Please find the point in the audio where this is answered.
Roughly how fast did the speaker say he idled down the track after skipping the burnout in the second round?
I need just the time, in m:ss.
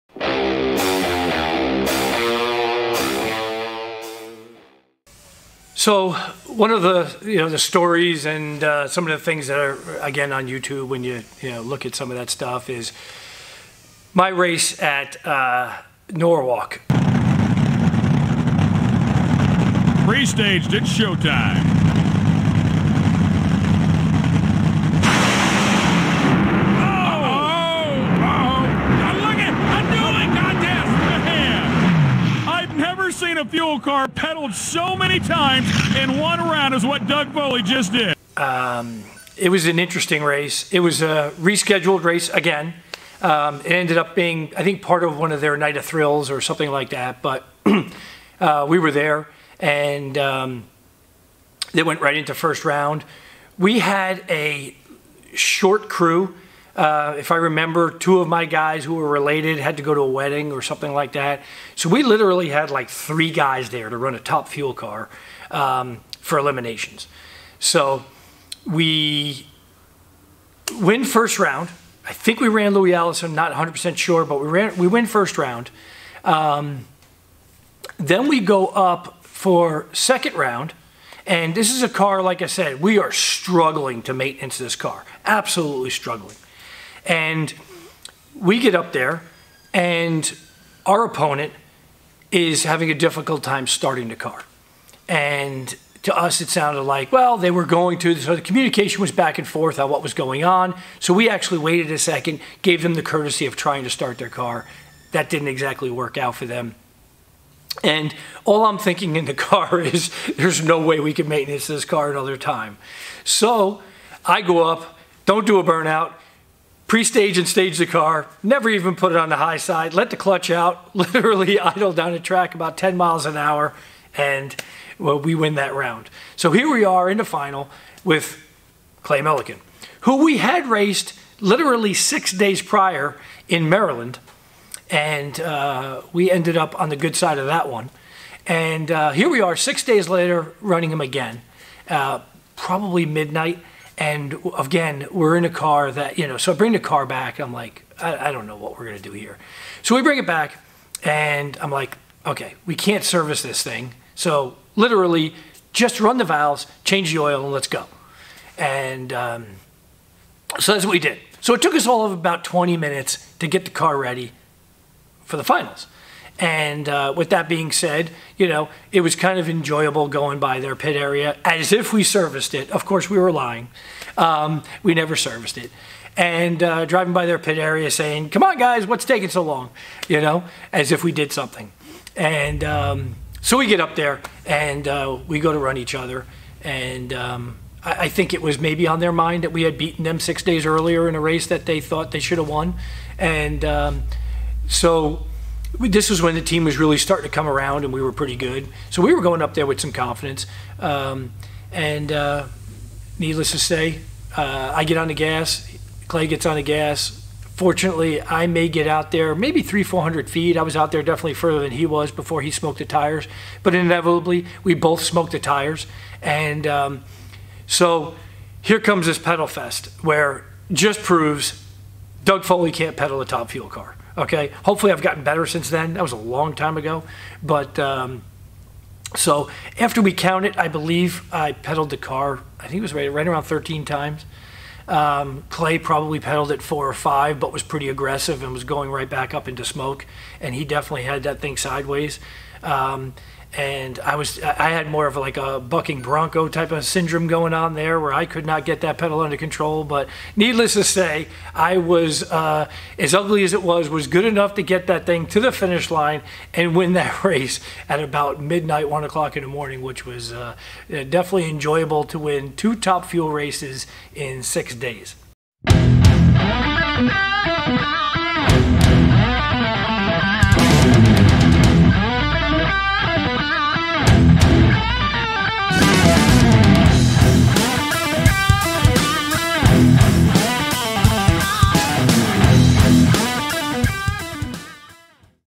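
2:02.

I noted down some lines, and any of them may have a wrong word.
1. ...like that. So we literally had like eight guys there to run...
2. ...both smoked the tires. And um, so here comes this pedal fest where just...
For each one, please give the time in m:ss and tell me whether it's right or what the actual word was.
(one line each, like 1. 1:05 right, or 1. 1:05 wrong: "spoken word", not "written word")
1. 1:00 wrong: "three", not "eight"
2. 3:34 right.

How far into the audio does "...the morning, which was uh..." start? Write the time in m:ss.
4:19.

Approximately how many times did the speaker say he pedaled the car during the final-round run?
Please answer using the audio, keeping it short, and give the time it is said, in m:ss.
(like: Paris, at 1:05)
13, at 3:53.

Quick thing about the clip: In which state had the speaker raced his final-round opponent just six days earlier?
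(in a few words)
Maryland.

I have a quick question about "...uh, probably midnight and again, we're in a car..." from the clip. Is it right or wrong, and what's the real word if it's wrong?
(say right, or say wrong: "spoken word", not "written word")
right.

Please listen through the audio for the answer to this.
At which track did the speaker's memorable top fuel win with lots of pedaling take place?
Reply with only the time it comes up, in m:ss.
0:16.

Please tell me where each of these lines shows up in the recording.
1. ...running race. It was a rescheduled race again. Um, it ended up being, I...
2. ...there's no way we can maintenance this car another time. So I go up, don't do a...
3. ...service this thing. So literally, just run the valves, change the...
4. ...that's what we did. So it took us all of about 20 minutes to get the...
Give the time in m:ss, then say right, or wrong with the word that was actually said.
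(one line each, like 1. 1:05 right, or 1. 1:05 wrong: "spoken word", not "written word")
1. 0:39 wrong: "interesting", not "running"
2. 1:50 right
3. 2:33 right
4. 2:40 right.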